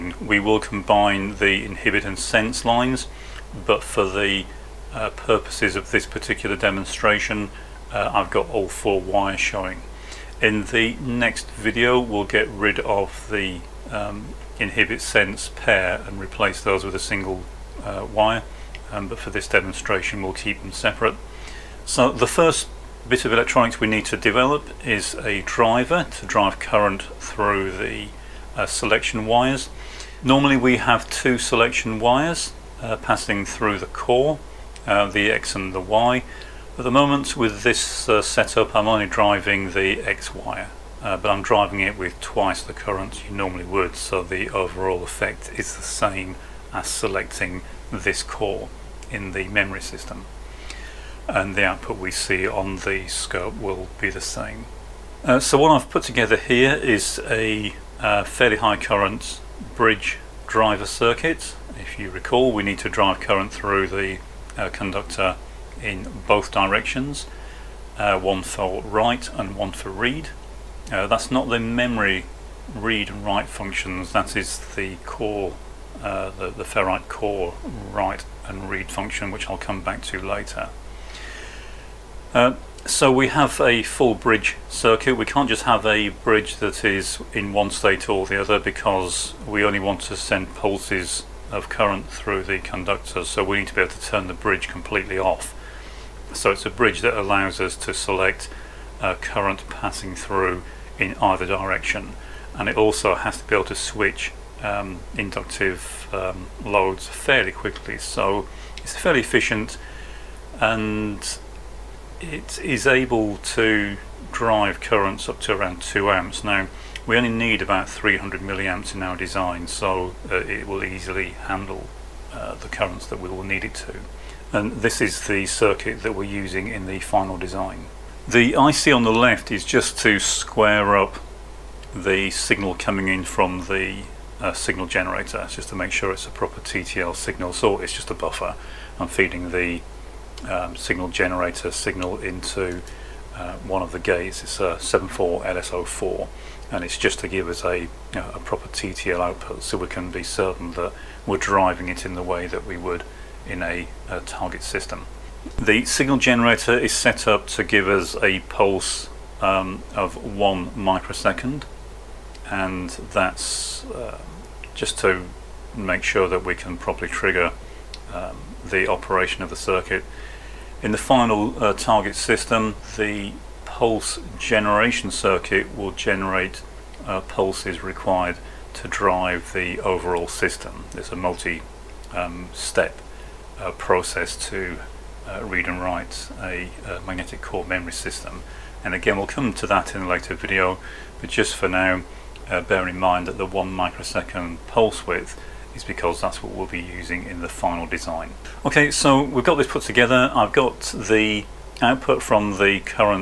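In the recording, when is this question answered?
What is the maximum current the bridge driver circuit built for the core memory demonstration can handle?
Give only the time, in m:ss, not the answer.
1:55.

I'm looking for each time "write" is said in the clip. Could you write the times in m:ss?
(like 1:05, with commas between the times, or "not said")
1:08, 1:13, 1:17, 3:05.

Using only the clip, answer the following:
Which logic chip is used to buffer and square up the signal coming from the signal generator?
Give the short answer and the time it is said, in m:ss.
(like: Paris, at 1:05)
74LS04, at 2:24.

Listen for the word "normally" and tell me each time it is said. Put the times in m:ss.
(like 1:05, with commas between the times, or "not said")
0:30, 0:43.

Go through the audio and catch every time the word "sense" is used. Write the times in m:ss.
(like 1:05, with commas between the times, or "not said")
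0:02, 0:14.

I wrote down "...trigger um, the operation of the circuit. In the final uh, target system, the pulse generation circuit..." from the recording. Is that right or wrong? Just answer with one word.
right.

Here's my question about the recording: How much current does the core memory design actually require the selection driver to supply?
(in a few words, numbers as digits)
300 milliamps.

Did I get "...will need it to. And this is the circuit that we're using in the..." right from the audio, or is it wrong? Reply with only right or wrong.
right.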